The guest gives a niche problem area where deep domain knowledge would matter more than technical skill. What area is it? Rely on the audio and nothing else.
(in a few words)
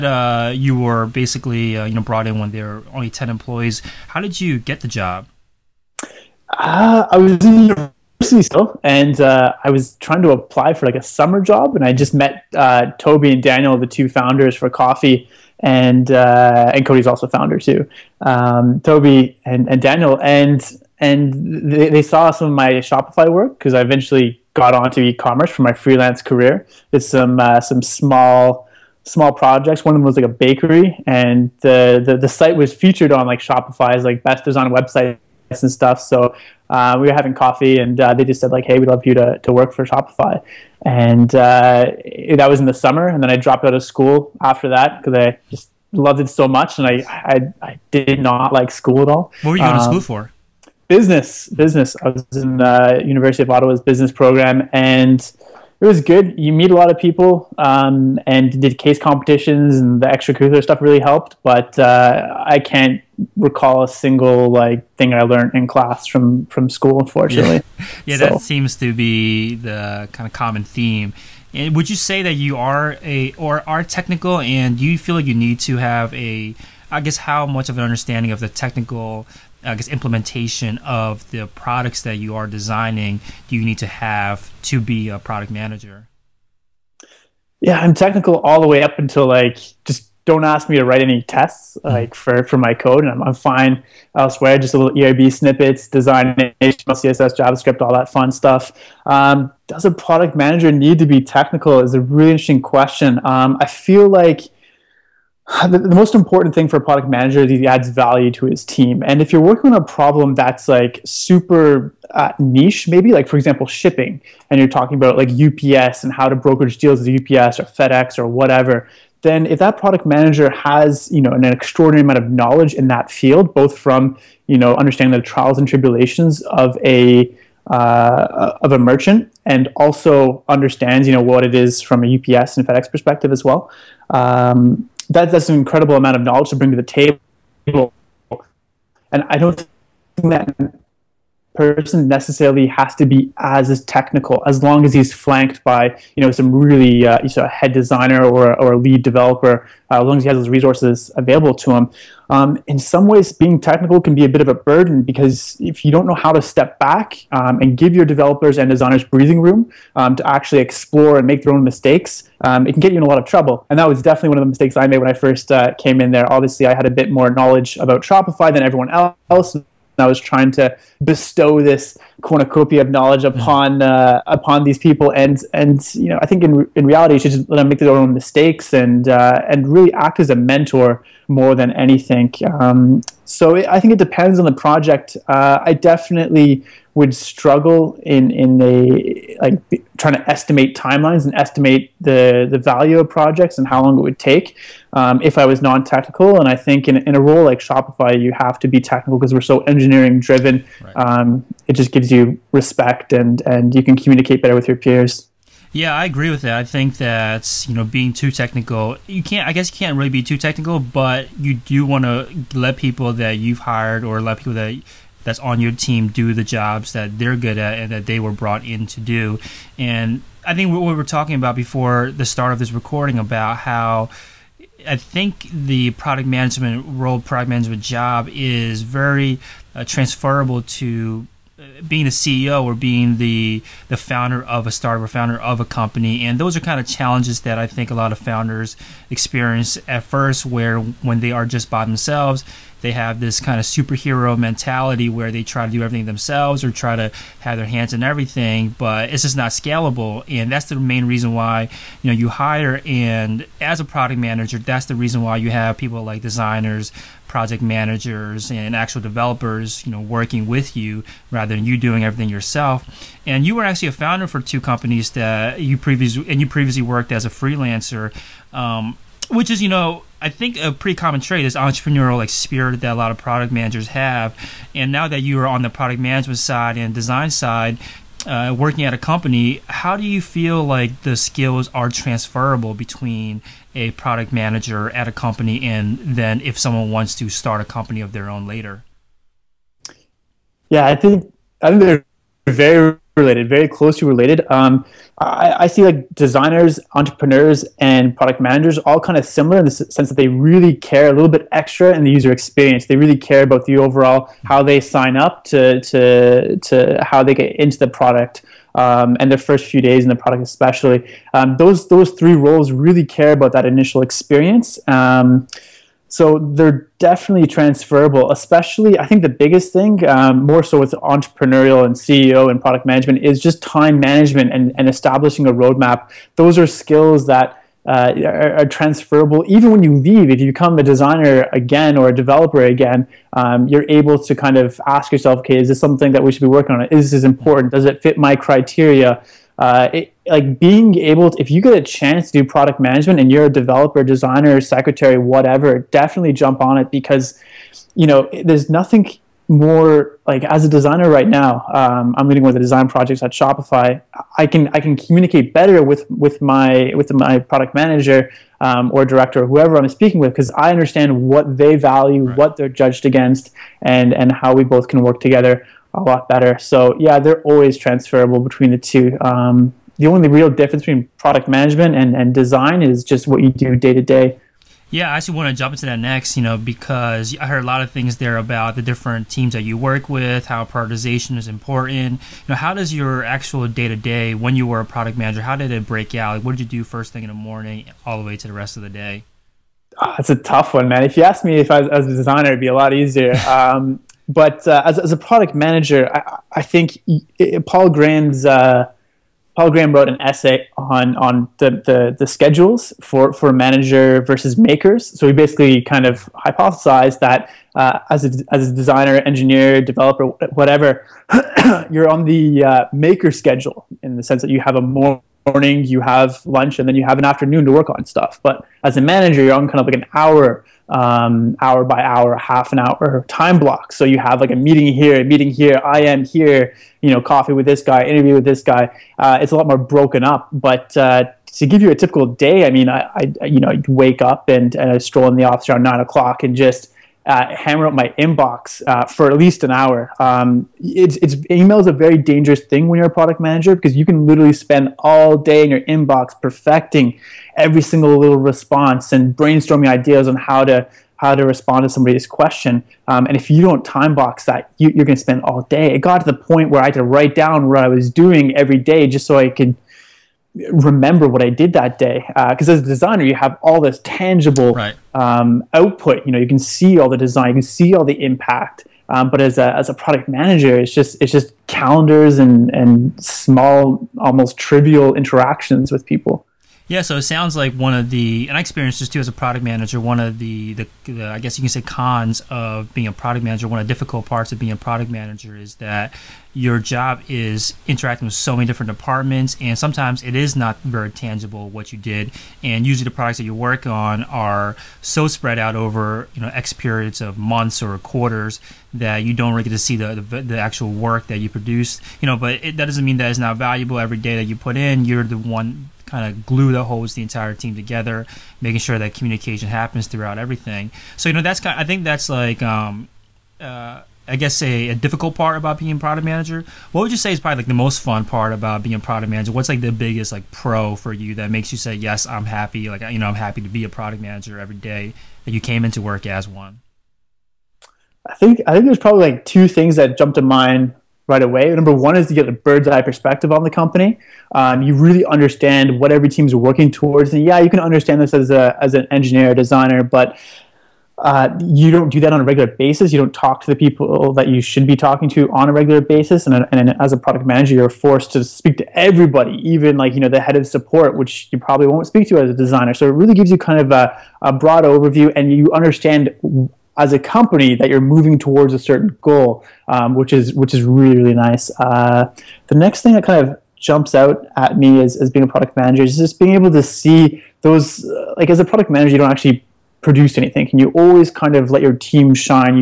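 Shipping.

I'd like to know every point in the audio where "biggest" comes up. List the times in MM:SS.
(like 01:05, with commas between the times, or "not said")
05:19, 08:39.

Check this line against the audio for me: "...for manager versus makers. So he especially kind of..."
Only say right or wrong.
wrong.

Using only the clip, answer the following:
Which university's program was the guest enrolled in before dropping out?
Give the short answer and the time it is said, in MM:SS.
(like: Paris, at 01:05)
University of Ottawa, at 00:53.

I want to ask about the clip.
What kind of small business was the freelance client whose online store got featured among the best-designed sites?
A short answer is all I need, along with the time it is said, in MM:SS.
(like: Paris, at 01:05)
A bakery, at 00:30.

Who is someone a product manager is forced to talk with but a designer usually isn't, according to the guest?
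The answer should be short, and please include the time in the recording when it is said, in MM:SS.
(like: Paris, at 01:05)
Head of support, at 09:10.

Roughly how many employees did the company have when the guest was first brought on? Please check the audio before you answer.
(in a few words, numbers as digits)
10.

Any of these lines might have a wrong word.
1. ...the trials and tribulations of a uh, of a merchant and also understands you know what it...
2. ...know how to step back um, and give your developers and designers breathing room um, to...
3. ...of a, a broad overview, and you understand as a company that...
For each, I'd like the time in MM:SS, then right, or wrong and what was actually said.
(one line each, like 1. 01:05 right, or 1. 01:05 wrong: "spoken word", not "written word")
1. 02:05 right
2. 02:36 right
3. 09:13 right.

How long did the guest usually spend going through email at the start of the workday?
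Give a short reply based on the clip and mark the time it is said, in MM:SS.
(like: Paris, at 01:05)
At least an hour, at 07:19.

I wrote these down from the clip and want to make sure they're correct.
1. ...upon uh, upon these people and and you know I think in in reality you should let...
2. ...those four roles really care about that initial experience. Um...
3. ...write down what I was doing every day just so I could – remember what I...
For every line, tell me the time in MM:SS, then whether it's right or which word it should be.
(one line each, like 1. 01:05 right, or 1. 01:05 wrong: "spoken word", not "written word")
1. 02:53 right
2. 05:11 wrong: "three", not "four"
3. 07:37 right.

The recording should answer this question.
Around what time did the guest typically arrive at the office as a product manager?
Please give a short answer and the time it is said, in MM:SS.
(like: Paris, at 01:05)
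9 o'clock, at 07:15.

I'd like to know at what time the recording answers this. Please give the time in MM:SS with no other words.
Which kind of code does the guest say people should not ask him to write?
01:31.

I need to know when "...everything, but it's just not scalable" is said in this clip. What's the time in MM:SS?
04:08.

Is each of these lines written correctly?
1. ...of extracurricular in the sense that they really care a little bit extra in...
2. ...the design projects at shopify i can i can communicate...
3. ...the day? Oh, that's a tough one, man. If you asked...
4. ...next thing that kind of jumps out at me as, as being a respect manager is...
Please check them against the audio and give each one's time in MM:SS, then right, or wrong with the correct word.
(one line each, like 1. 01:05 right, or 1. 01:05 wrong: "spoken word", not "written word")
1. 04:59 wrong: "similar", not "extracurricular"
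2. 05:52 right
3. 06:28 right
4. 09:22 wrong: "product", not "respect".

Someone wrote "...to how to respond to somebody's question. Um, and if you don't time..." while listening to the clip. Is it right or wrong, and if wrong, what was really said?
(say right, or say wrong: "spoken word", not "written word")
right.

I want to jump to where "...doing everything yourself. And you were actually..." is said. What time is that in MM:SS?
04:21.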